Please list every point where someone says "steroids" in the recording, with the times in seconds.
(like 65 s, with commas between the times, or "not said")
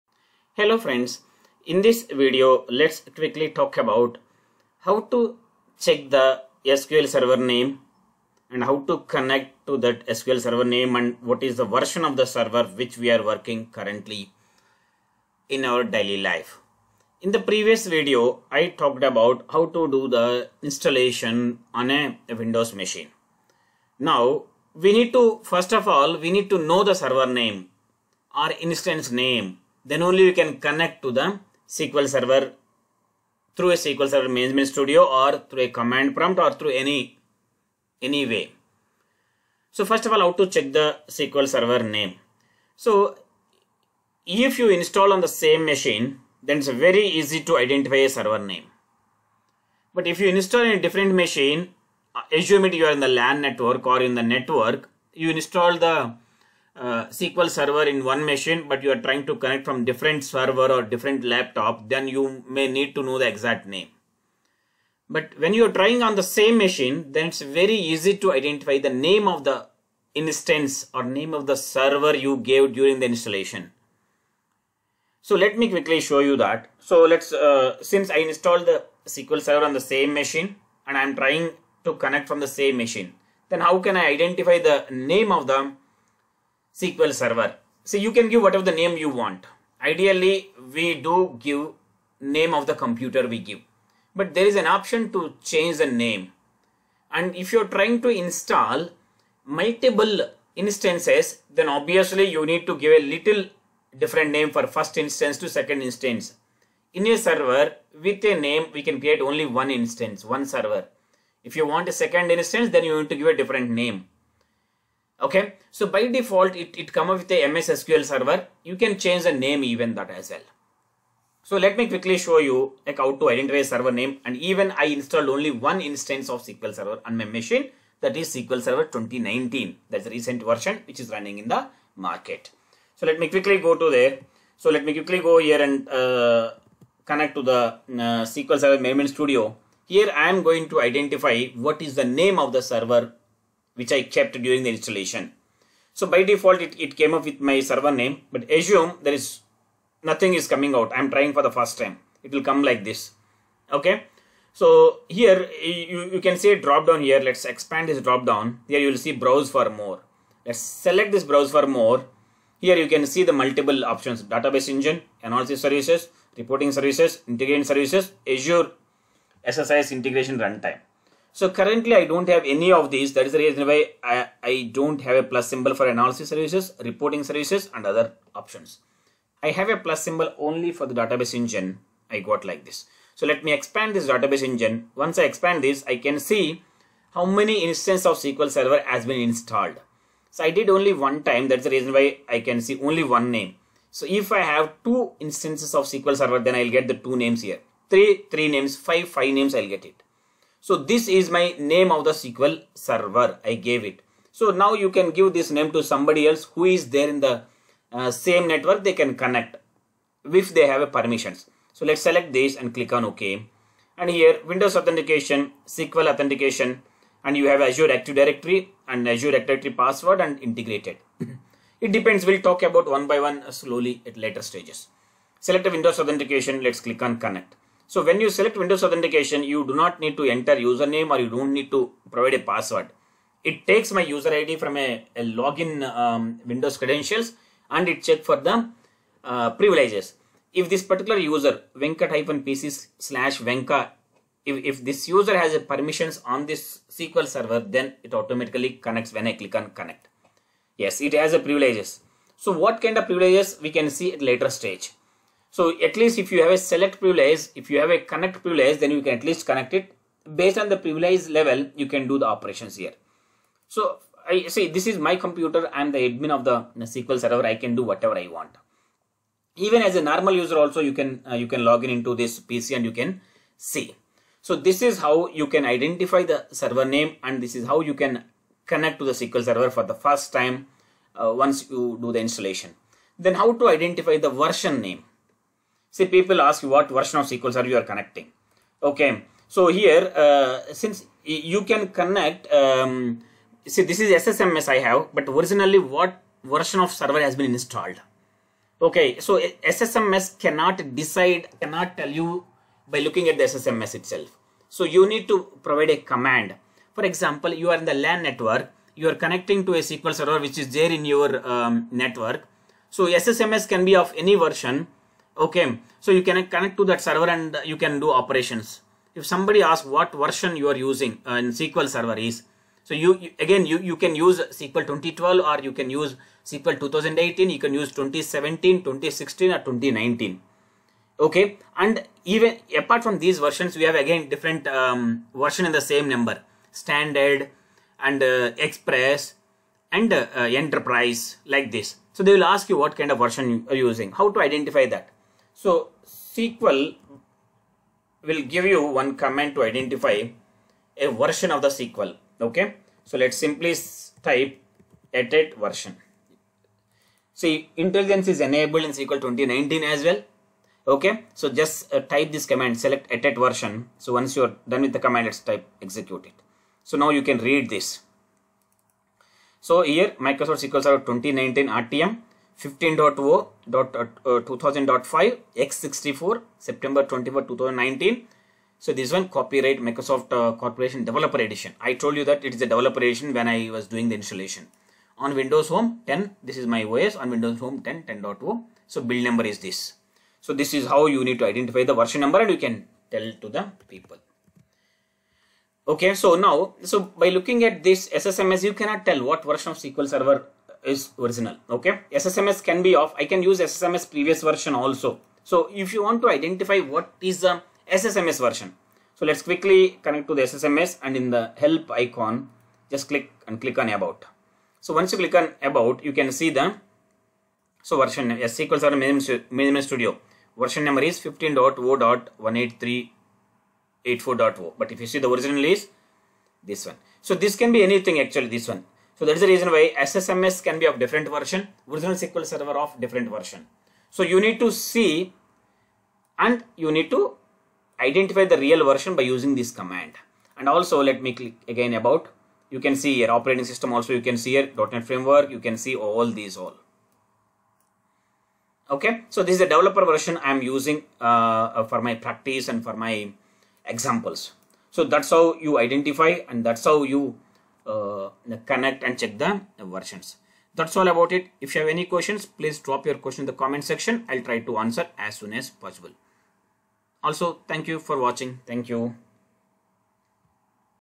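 not said.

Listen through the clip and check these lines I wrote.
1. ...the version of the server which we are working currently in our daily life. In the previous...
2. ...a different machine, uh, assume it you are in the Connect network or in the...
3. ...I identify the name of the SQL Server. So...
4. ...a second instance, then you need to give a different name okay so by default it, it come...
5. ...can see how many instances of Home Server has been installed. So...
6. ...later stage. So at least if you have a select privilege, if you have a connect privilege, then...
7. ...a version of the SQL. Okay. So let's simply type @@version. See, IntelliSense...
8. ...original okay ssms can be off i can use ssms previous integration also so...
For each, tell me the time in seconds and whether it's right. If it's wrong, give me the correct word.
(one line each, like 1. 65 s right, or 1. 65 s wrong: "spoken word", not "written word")
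1. 11 s right
2. 50 s wrong: "LAN", not "Connect"
3. 83 s right
4. 111 s right
5. 185 s wrong: "SQL", not "Home"
6. 254 s right
7. 350 s right
8. 401 s wrong: "version", not "integration".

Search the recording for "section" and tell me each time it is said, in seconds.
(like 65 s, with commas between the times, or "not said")
463 s.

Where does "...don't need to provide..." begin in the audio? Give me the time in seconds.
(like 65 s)
231 s.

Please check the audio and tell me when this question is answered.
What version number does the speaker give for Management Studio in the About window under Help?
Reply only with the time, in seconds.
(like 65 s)
421 s.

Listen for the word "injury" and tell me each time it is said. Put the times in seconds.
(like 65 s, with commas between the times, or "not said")
not said.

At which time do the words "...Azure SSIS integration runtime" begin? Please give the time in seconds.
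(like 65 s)
168 s.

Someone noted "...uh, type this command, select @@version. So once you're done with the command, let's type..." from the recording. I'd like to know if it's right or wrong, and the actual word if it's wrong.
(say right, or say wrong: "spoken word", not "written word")
right.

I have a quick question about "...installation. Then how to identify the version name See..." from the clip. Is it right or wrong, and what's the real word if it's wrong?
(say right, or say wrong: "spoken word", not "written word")
right.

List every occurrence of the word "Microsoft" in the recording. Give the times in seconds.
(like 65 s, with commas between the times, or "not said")
370 s, 379 s.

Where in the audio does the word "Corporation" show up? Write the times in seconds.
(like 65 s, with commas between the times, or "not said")
380 s.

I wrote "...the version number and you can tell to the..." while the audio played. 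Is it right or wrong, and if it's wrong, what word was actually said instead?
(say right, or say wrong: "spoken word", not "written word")
right.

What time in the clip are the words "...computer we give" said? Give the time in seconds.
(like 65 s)
92 s.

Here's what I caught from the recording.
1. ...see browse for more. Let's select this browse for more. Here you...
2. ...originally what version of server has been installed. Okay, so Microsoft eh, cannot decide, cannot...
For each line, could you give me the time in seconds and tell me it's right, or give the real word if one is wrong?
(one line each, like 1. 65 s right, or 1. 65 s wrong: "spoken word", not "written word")
1. 158 s right
2. 295 s wrong: "SSMS", not "Microsoft".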